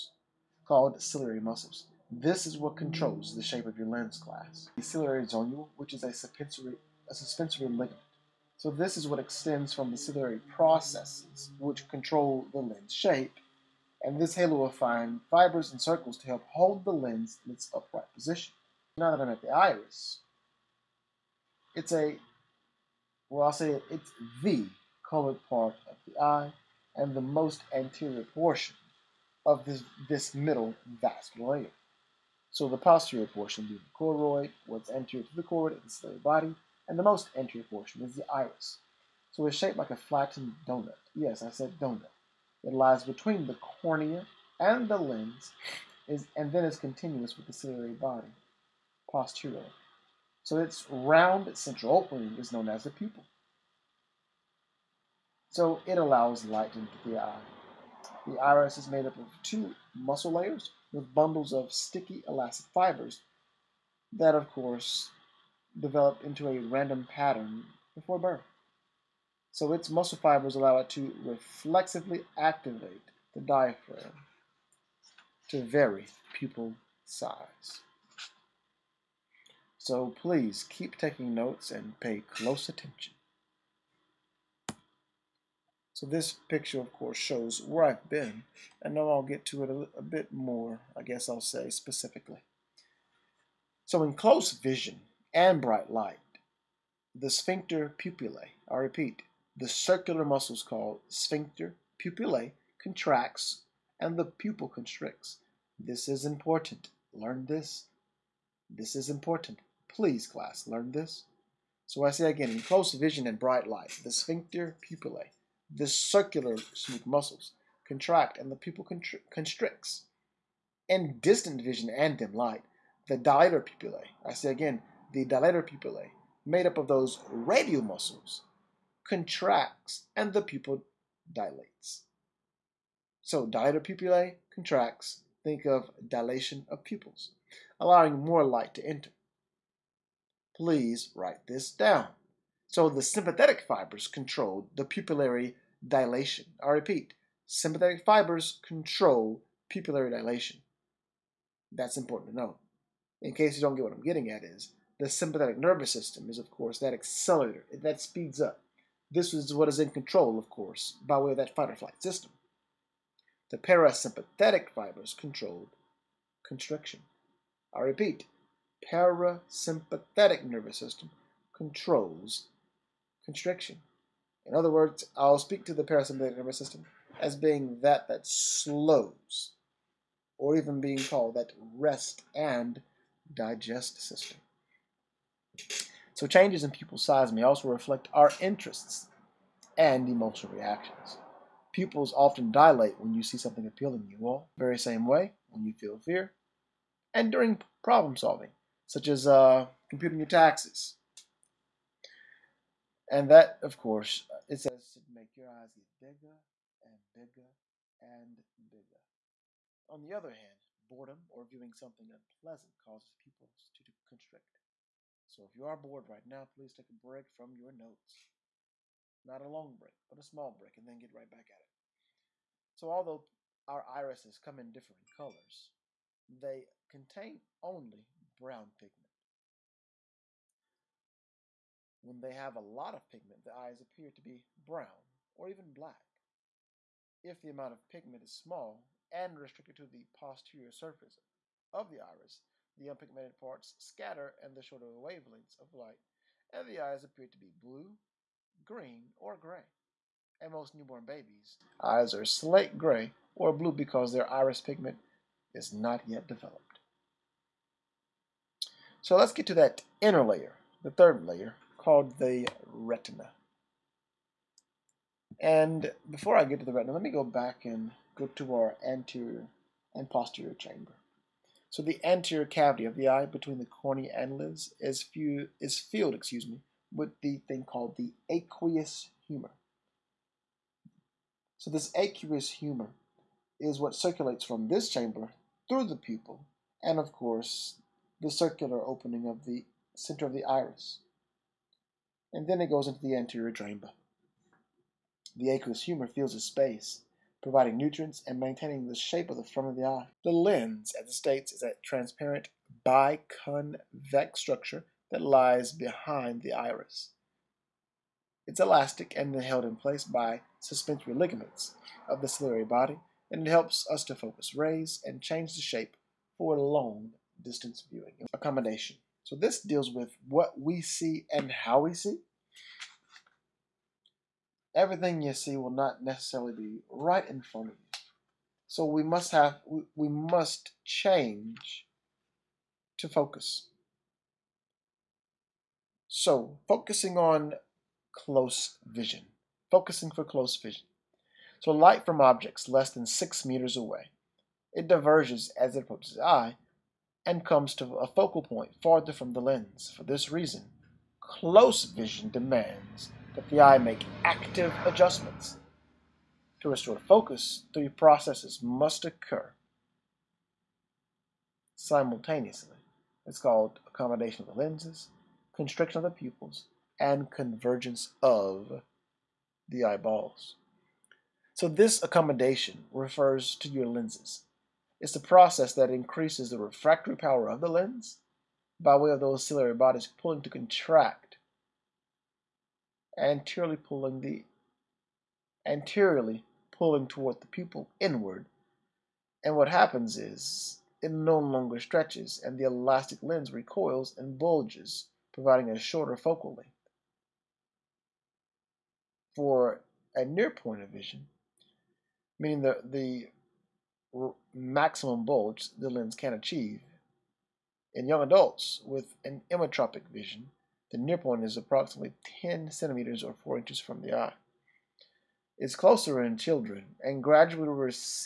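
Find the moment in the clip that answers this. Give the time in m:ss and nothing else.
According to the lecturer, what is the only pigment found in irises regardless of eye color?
3:48.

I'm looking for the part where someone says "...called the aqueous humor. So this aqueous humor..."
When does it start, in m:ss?
4:37.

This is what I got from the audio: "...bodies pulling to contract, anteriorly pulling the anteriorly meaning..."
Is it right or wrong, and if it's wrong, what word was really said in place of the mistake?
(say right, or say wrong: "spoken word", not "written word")
wrong: "pulling", not "meaning".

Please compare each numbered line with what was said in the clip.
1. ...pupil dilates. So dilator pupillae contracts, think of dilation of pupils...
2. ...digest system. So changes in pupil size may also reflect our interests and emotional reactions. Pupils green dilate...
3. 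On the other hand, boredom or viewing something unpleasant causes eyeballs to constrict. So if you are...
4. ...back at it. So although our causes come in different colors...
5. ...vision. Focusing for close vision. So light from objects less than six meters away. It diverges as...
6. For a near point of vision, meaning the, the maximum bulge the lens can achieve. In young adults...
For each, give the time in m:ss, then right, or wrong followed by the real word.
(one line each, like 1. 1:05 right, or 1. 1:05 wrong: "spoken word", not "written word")
1. 2:10 right
2. 3:03 wrong: "often", not "green"
3. 3:29 wrong: "pupils", not "eyeballs"
4. 3:41 wrong: "irises", not "causes"
5. 5:38 right
6. 6:39 right.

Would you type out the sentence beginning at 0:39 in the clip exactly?
So it's shaped like a flattened donut.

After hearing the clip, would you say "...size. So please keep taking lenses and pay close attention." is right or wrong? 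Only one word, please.
wrong.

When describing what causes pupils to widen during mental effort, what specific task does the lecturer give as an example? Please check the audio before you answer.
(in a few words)
Computing your taxes.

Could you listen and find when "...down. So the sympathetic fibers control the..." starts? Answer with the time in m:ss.
2:21.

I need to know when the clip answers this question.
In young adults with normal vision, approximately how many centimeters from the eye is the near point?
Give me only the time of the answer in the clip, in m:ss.
6:52.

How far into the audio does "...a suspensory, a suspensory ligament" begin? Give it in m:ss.
0:06.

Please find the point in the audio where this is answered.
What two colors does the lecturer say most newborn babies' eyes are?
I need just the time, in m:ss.
4:12.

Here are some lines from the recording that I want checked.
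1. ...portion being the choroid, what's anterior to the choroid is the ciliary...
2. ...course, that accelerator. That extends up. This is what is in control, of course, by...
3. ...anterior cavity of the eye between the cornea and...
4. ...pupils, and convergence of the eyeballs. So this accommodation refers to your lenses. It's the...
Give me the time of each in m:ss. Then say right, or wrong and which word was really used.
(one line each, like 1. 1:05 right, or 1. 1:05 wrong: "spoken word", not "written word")
1. 0:33 right
2. 2:36 wrong: "speeds", not "extends"
3. 4:32 right
4. 6:06 right.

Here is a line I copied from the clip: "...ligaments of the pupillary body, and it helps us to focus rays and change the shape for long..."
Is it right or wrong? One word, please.
wrong.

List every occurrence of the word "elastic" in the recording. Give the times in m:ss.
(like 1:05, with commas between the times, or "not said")
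1:02, 5:08, 6:32.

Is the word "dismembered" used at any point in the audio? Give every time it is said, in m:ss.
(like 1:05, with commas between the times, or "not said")
not said.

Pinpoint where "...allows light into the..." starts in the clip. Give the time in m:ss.
0:55.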